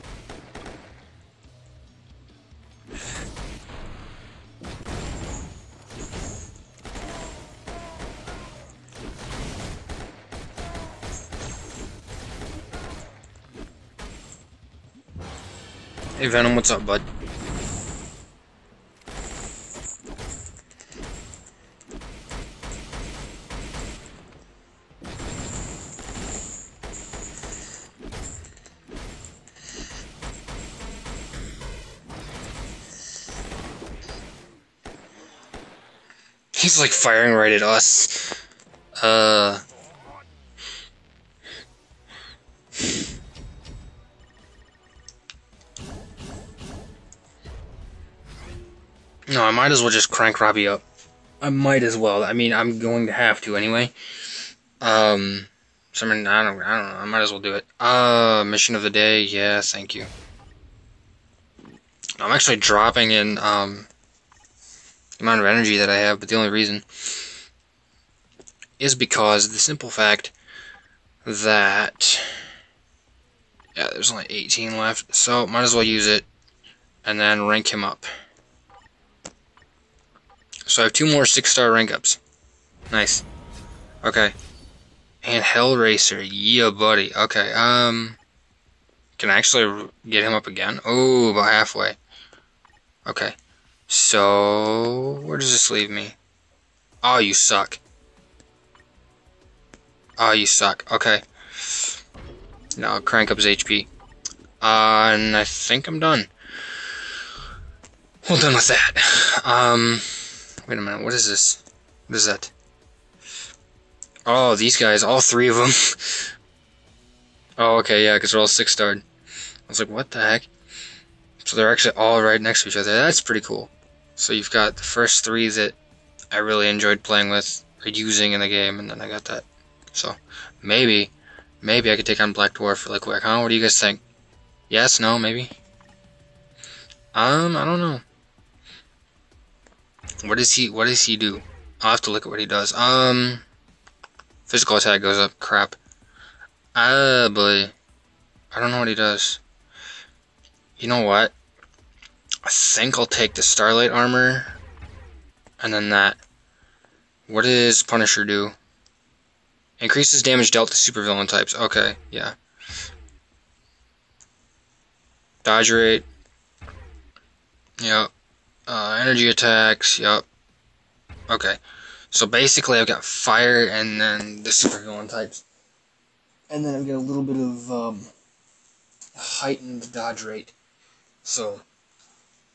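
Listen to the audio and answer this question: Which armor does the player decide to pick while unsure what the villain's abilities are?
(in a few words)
Starlight armor.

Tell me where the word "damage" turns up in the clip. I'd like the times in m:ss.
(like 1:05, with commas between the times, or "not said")
2:40.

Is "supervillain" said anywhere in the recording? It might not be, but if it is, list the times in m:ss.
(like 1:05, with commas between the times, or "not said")
2:40, 2:54.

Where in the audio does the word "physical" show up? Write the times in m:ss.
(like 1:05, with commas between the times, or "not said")
2:24.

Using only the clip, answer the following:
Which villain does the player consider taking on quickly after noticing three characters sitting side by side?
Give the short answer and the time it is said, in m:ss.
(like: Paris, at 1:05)
Black Dwarf, at 2:12.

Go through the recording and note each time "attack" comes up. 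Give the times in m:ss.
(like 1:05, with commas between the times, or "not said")
2:24, 2:49.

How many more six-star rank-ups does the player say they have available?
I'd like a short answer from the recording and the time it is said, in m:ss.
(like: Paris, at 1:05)
2, at 1:20.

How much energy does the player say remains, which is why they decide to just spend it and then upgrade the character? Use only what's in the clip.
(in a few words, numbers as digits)
18.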